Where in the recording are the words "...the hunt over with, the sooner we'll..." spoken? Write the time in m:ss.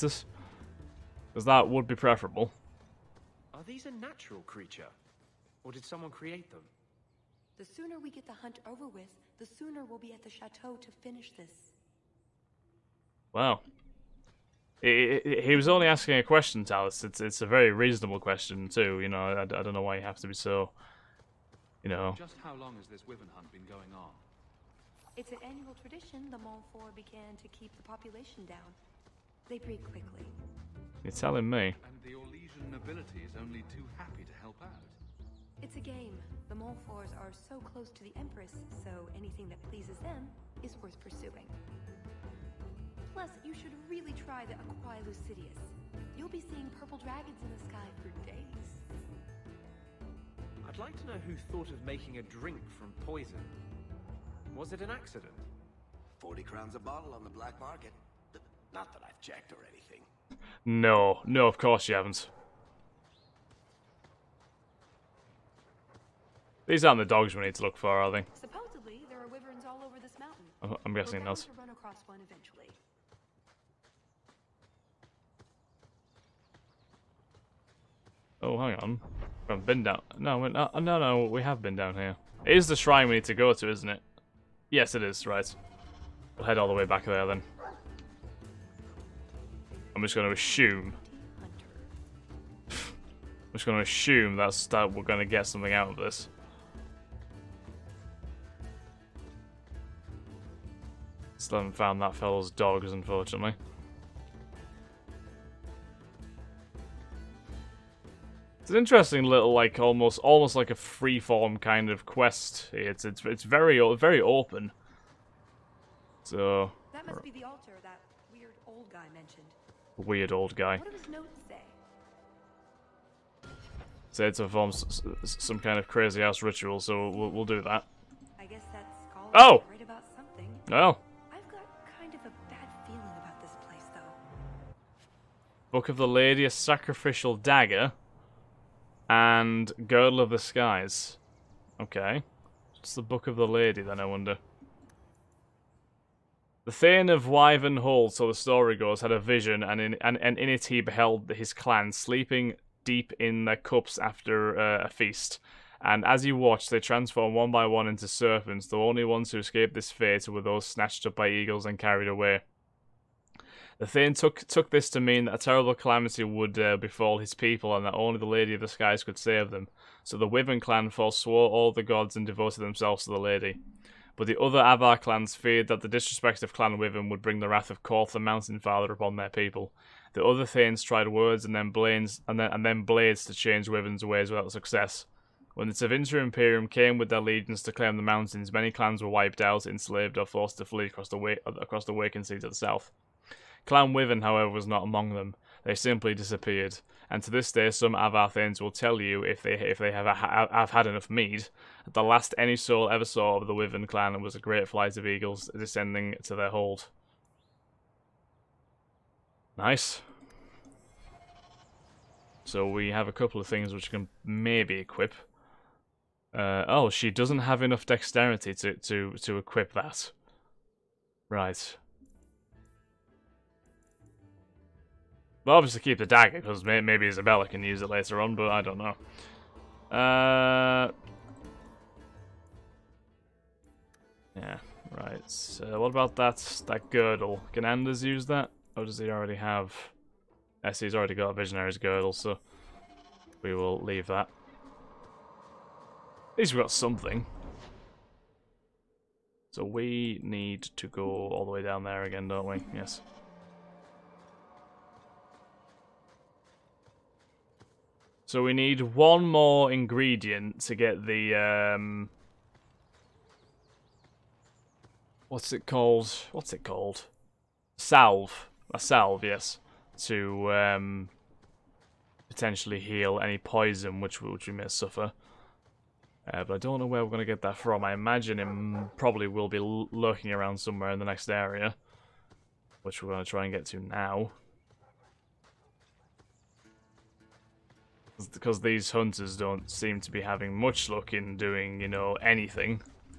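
0:08.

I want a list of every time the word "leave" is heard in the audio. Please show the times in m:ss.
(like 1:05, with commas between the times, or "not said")
4:03.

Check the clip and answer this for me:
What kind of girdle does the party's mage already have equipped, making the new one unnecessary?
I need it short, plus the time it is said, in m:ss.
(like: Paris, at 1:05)
Visionary's Girdle, at 4:01.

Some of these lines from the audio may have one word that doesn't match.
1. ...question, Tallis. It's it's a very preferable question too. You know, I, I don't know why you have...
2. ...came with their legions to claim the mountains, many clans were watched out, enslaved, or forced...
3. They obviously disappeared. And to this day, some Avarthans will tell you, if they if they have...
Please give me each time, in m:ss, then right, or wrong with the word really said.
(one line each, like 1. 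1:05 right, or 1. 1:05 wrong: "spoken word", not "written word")
1. 0:16 wrong: "reasonable", not "preferable"
2. 3:06 wrong: "wiped", not "watched"
3. 3:15 wrong: "simply", not "obviously".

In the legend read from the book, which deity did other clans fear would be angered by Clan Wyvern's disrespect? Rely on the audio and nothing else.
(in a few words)
Korth the Mountain Father.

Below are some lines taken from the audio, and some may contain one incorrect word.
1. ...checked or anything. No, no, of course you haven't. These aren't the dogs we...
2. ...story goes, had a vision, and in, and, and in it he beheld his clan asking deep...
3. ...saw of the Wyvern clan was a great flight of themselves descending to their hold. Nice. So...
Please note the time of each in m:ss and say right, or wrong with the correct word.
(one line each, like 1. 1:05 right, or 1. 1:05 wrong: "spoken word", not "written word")
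1. 0:59 right
2. 2:28 wrong: "sleeping", not "asking"
3. 3:23 wrong: "eagles", not "themselves".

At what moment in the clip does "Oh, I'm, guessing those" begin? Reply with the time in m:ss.
1:10.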